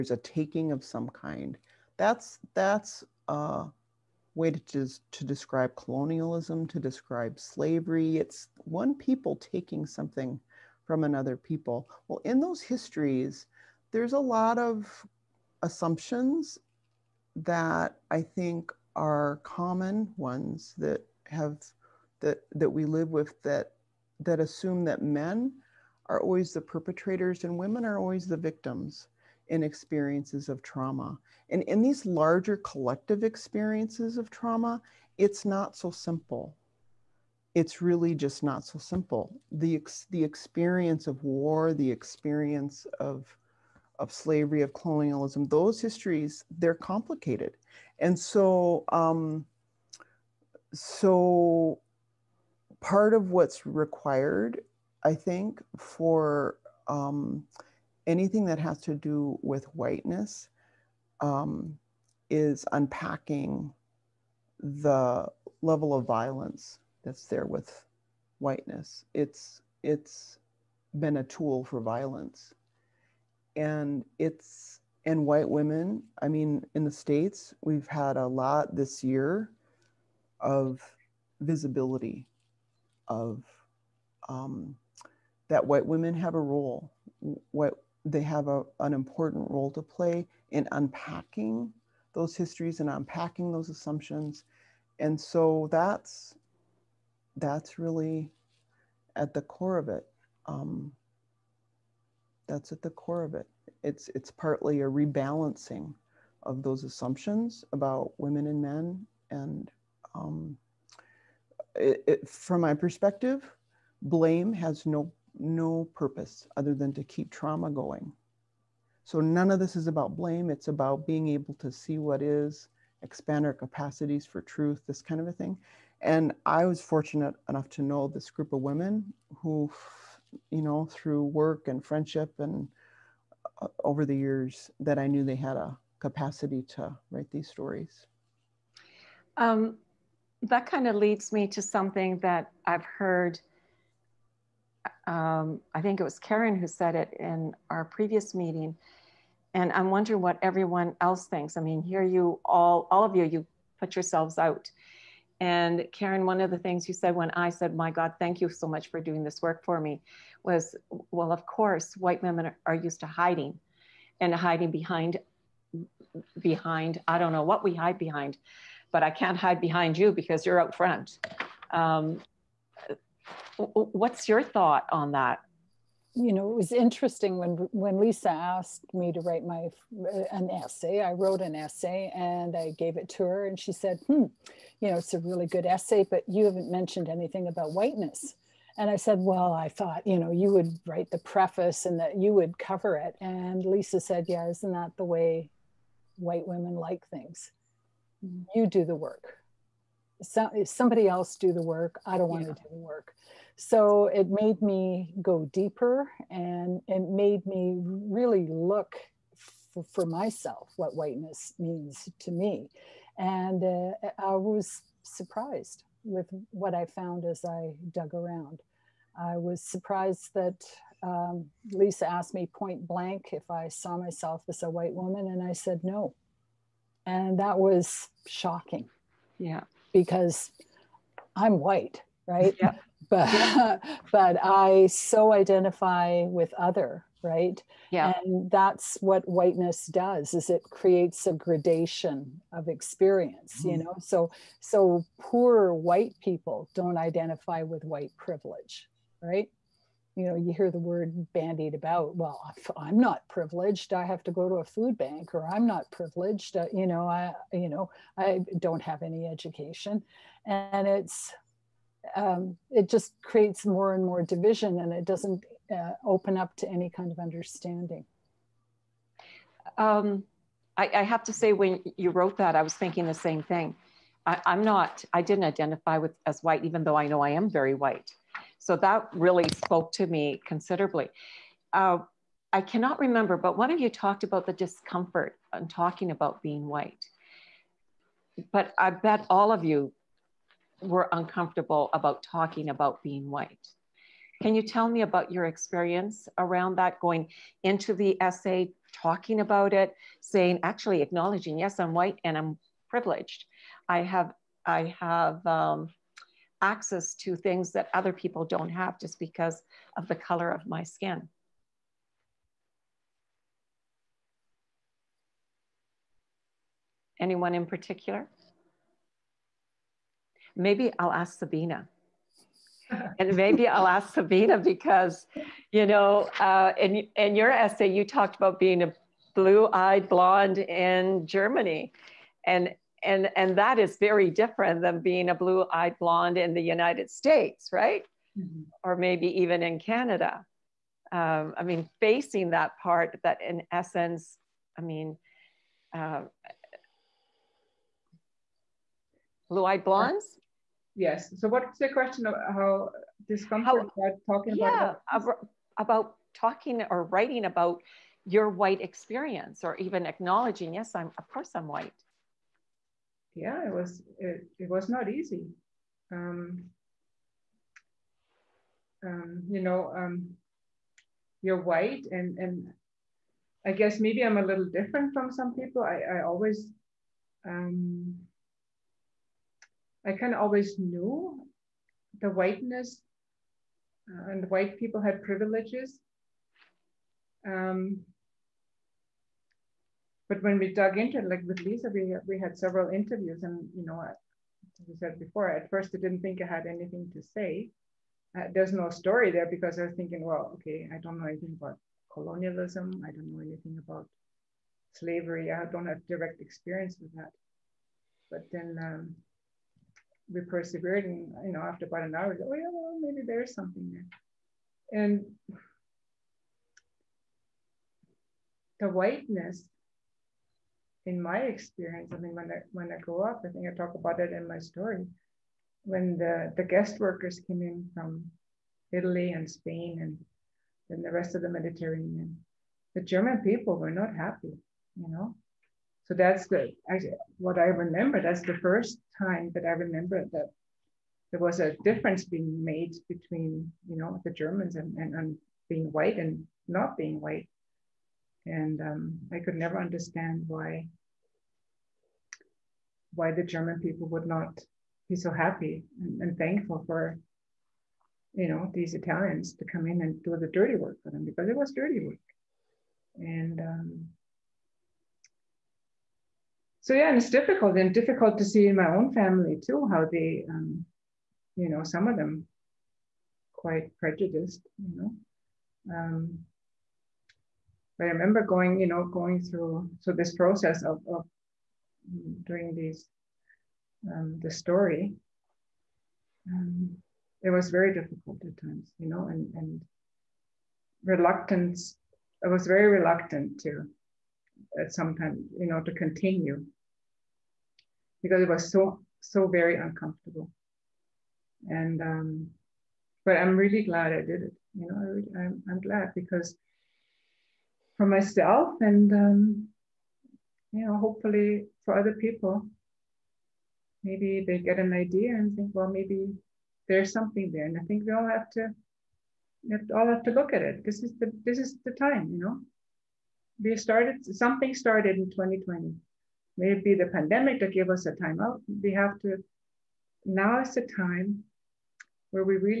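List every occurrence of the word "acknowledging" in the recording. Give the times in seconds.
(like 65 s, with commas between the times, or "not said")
300 s, 360 s.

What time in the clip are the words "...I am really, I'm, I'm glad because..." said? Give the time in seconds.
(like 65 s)
504 s.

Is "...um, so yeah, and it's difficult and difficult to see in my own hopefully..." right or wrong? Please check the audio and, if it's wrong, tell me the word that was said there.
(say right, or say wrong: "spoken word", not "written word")
wrong: "family", not "hopefully".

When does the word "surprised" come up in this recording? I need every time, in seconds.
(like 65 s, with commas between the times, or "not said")
215 s, 219 s.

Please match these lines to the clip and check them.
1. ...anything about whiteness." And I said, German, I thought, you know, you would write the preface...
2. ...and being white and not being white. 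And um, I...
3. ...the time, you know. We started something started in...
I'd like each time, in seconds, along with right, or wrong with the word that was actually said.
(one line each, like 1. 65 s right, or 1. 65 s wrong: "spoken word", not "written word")
1. 187 s wrong: "Well", not "German"
2. 445 s right
3. 521 s right.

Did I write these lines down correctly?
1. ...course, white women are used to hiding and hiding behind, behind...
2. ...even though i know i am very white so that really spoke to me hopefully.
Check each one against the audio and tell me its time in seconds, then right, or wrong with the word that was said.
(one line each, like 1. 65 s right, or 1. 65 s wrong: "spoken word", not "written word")
1. 161 s right
2. 276 s wrong: "considerably", not "hopefully".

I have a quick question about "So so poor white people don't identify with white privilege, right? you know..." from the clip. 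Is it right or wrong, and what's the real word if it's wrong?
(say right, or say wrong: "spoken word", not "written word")
right.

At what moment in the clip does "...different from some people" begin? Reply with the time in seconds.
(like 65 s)
374 s.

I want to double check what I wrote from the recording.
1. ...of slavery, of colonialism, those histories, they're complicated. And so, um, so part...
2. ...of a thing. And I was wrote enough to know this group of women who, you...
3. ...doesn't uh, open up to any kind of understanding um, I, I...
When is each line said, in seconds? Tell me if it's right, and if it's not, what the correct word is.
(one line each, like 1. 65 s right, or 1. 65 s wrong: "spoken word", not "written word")
1. 43 s right
2. 125 s wrong: "fortunate", not "wrote"
3. 265 s right.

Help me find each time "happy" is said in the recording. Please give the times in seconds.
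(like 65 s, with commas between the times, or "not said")
434 s, 455 s.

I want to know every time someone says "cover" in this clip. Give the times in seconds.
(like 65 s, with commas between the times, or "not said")
192 s.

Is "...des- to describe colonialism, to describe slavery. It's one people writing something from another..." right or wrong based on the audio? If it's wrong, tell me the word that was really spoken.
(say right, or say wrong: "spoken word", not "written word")
wrong: "taking", not "writing".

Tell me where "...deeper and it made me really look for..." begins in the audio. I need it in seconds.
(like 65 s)
205 s.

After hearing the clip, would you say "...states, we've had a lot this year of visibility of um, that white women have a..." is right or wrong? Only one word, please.
right.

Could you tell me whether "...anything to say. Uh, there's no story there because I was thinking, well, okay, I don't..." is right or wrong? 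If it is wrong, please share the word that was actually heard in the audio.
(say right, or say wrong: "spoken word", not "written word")
right.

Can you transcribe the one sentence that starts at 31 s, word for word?
And in these larger collective experiences of trauma, it's not so simple.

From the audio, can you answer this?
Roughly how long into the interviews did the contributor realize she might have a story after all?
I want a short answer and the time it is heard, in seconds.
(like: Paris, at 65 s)
About an hour, at 411 s.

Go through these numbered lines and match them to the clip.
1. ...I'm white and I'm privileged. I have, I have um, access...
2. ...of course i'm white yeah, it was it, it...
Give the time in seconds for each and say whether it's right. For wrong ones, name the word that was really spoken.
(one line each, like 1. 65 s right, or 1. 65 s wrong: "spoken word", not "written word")
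1. 301 s right
2. 361 s right.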